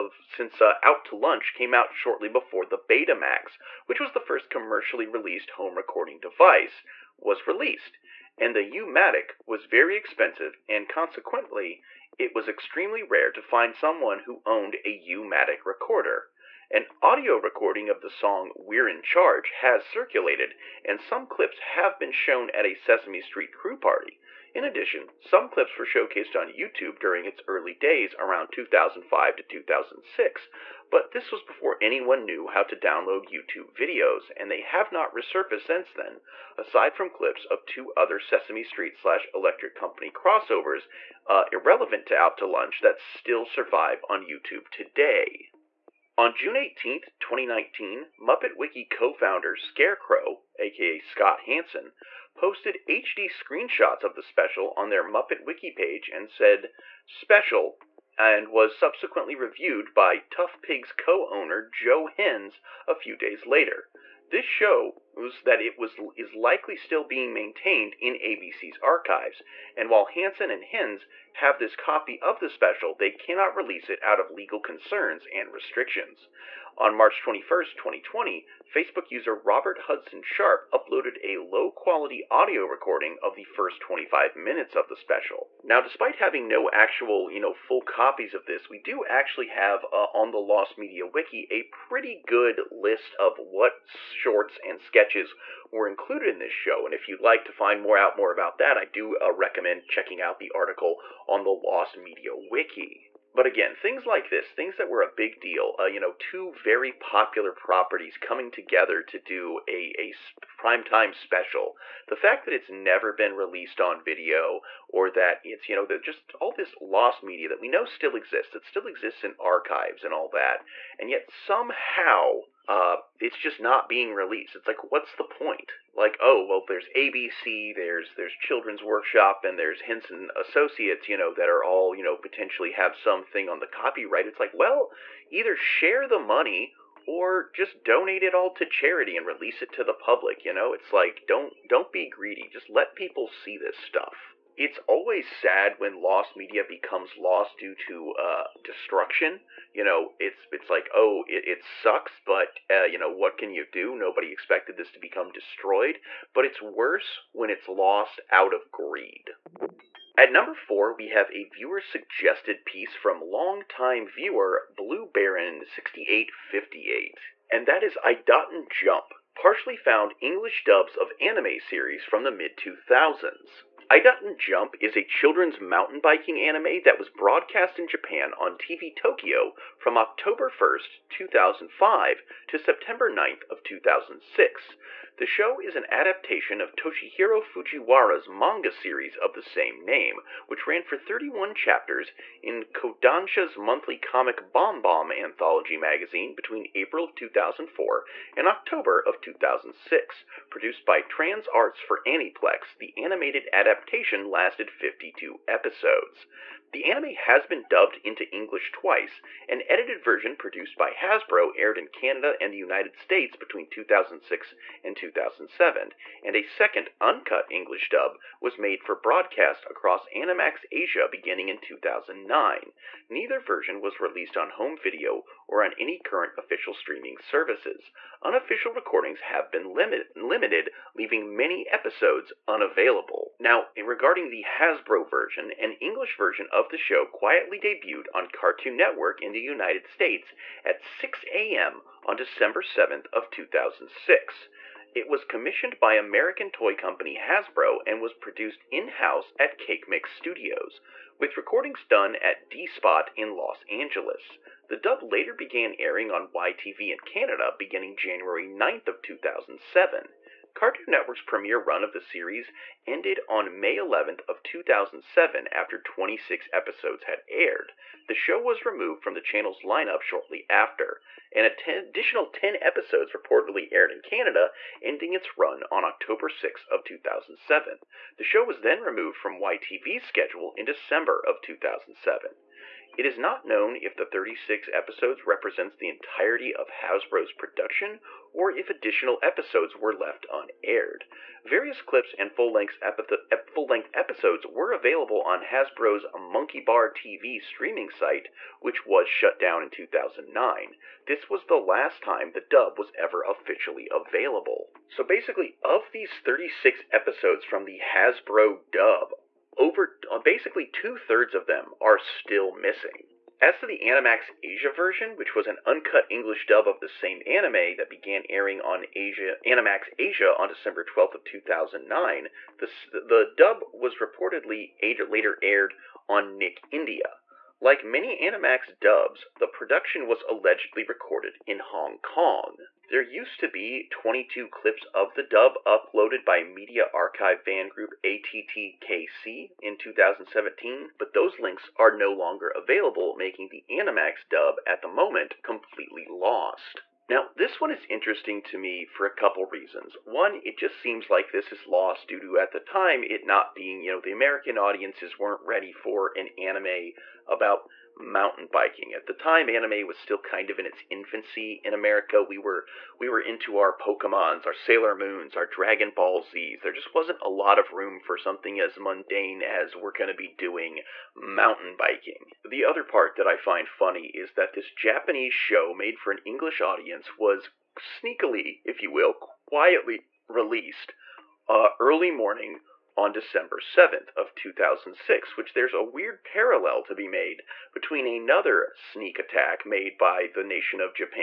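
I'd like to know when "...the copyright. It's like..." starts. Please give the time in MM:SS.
02:13.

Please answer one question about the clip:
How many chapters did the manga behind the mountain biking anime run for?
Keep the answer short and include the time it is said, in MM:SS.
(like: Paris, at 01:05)
31, at 03:10.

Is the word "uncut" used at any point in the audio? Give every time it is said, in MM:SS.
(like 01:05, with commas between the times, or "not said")
03:37, 05:15.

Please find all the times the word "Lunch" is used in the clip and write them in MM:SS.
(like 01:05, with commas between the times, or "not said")
00:01, 00:42.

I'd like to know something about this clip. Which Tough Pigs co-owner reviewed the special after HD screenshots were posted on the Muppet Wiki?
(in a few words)
Joe Hennes.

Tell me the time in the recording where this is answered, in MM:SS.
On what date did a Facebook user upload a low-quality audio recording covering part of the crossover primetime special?
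01:16.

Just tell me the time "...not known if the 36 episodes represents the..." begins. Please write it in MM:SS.
04:43.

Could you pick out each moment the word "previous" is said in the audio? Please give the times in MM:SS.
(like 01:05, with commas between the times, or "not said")
not said.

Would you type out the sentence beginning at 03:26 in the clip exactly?
The anime has been dubbed into English twice.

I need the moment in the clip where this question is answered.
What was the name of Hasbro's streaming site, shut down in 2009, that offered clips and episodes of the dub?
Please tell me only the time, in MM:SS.
04:56.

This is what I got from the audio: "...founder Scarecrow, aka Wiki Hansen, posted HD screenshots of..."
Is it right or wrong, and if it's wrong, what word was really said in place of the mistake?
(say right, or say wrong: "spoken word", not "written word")
wrong: "Scott", not "Wiki".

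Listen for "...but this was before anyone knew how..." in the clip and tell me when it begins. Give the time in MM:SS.
00:30.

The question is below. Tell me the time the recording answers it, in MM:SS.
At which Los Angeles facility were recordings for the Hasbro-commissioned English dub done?
04:12.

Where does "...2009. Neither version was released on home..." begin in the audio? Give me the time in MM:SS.
03:41.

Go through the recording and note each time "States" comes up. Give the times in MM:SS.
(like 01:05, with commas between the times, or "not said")
03:32, 03:59.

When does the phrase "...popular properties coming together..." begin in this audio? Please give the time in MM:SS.
01:46.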